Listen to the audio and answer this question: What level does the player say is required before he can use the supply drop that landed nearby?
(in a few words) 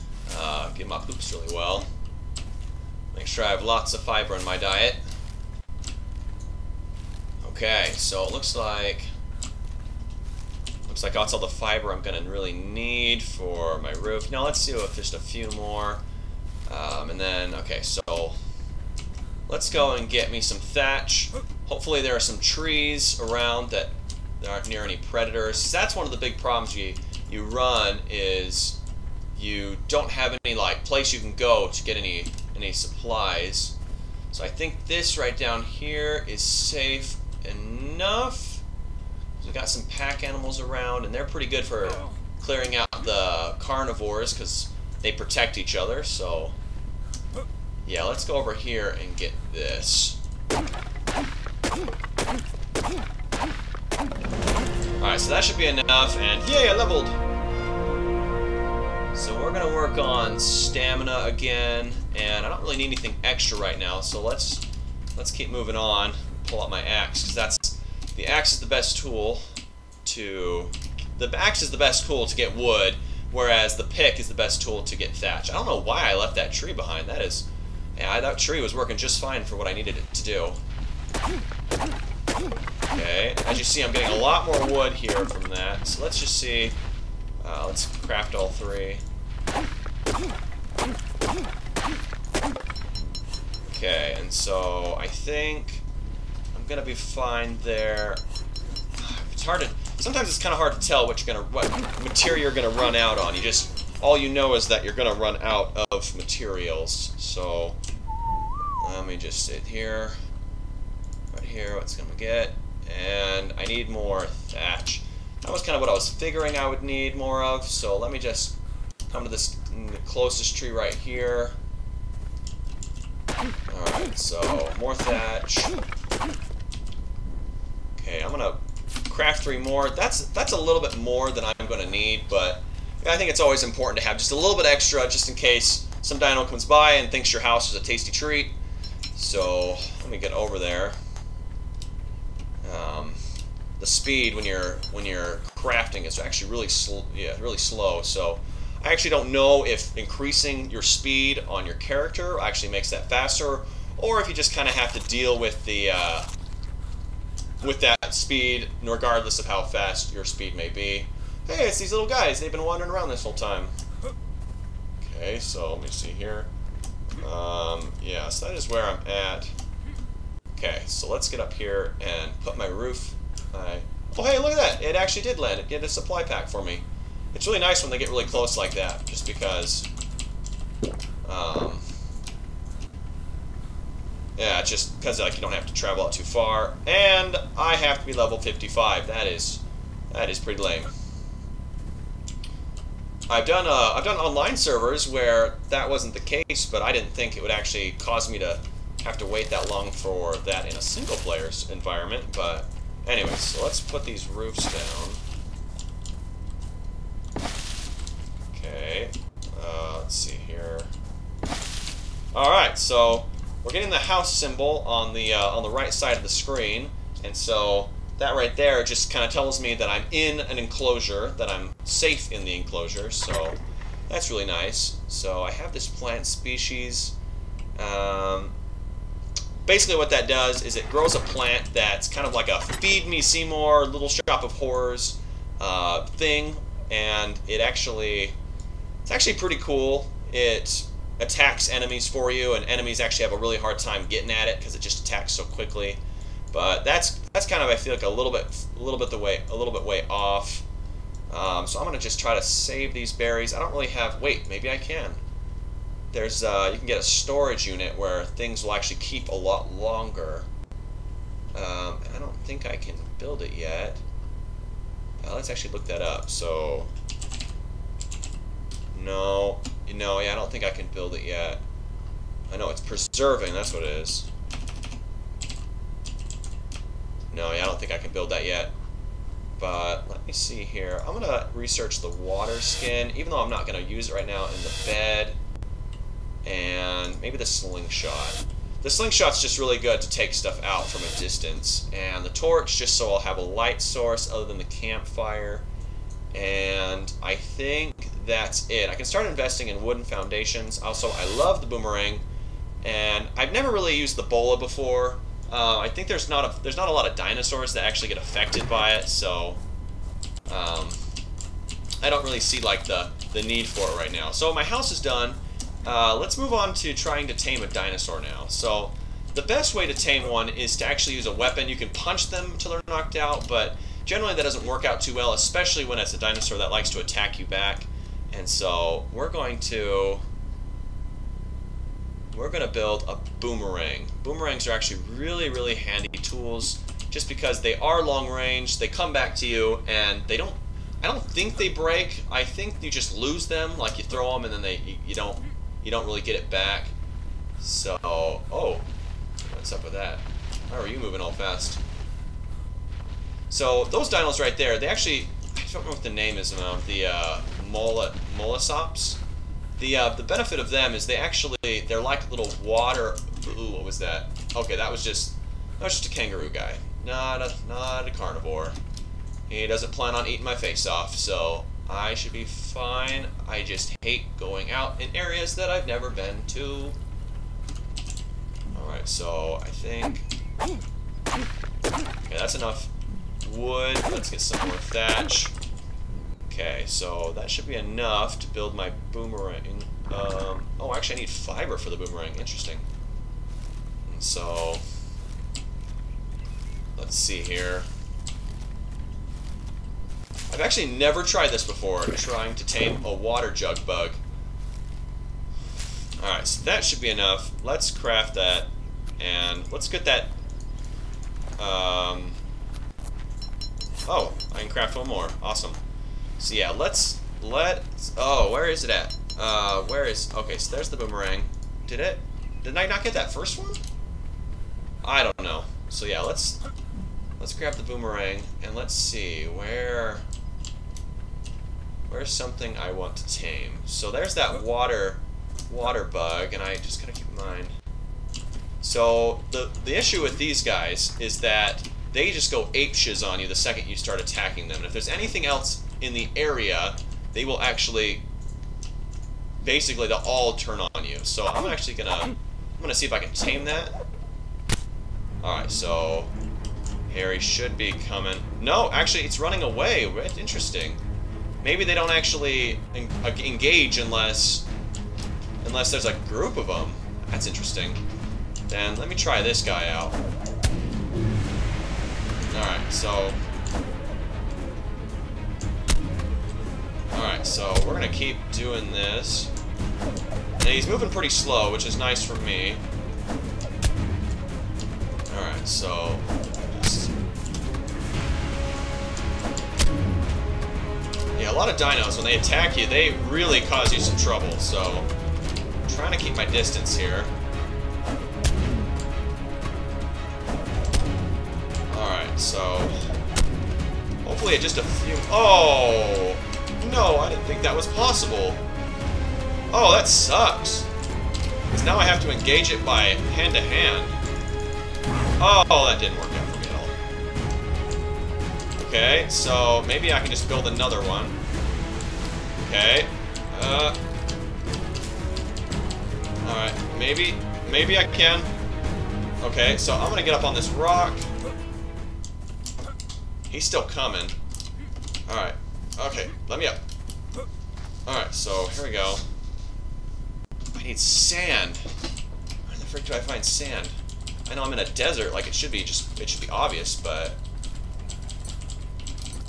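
55.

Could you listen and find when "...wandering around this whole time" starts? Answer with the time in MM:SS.
02:42.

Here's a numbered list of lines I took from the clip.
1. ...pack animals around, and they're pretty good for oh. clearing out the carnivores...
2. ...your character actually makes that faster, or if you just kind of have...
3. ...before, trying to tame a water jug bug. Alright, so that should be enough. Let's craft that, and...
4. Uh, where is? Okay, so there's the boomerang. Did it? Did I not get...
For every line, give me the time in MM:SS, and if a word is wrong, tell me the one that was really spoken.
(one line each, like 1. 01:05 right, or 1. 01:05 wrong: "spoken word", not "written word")
1. 00:39 right
2. 02:31 right
3. 06:41 right
4. 06:59 right.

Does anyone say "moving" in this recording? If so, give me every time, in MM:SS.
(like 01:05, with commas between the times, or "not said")
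01:05, 05:50, 08:00.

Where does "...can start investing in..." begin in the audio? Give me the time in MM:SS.
04:58.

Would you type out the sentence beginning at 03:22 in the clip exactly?
But anyway, so let's put these roofs down.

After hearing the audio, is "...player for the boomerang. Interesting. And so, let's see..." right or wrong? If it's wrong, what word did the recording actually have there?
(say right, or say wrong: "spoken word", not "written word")
wrong: "fiber", not "player".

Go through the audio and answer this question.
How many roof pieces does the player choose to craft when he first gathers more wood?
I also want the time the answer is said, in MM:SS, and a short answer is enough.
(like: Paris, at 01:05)
3, at 01:27.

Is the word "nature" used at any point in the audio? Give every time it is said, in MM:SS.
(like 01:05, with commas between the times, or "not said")
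not said.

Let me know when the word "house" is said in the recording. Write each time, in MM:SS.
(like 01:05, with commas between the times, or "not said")
02:17, 03:33, 05:14.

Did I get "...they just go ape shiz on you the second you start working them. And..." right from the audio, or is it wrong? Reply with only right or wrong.
wrong.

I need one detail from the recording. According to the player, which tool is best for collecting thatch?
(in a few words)
The pick.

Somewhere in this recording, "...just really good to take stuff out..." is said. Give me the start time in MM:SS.
04:49.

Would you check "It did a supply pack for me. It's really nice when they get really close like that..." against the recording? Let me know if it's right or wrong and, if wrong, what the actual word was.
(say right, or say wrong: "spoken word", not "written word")
right.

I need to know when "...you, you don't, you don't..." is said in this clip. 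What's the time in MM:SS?
05:44.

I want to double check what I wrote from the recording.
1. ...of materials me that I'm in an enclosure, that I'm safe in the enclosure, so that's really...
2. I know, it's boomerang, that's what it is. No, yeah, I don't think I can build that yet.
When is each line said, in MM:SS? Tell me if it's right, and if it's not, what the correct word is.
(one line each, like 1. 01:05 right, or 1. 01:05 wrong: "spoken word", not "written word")
1. 03:39 wrong: "tells", not "materials"
2. 04:32 wrong: "preserving", not "boomerang".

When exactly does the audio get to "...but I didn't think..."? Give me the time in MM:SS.
03:16.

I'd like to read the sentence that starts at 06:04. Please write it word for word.
Okay, that was just, that was just a kangaroo guy.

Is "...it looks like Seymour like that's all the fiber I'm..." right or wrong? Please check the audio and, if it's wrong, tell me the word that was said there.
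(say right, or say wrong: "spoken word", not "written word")
wrong: "Looks", not "Seymour".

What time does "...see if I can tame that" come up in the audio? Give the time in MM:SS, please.
07:32.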